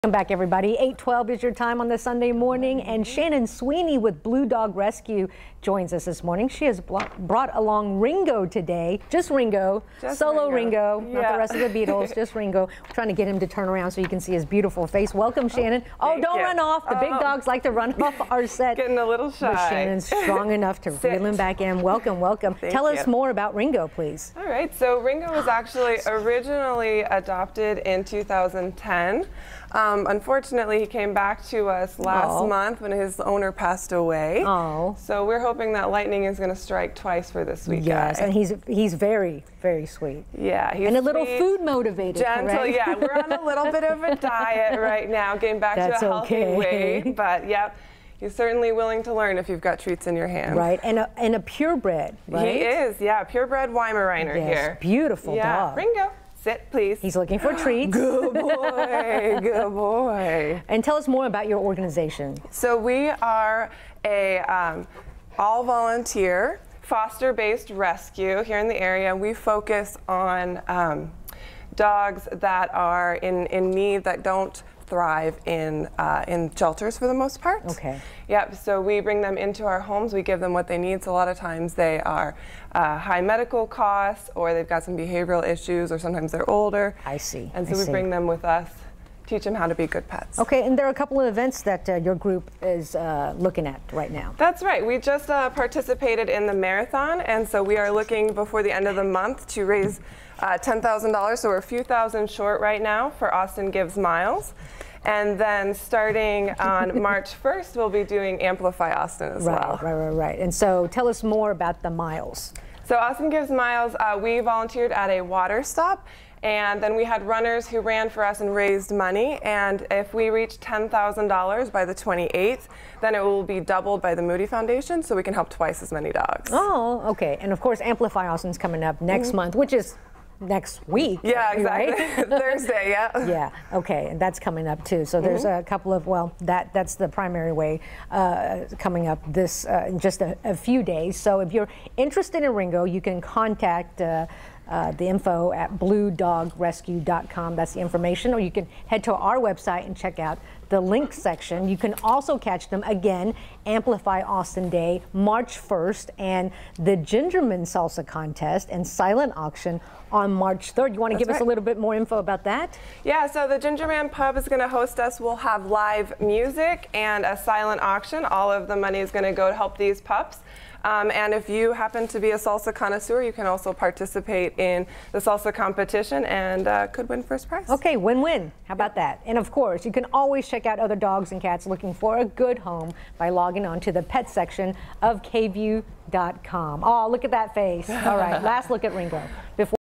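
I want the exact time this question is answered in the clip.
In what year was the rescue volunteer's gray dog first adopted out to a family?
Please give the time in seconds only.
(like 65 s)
28 s.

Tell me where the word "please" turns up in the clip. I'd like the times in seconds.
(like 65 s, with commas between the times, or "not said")
23 s, 56 s.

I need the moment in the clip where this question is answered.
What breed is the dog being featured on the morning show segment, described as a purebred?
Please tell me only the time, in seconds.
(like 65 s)
53 s.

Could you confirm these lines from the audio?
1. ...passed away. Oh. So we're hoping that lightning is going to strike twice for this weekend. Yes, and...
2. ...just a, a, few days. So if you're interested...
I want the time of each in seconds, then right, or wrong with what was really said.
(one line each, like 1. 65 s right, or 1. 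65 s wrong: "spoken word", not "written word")
1. 33 s right
2. 140 s right.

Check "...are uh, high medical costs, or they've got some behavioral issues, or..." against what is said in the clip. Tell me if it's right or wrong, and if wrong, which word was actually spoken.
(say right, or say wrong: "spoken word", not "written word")
right.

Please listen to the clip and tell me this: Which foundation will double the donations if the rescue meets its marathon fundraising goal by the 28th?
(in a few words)
Moody Foundation.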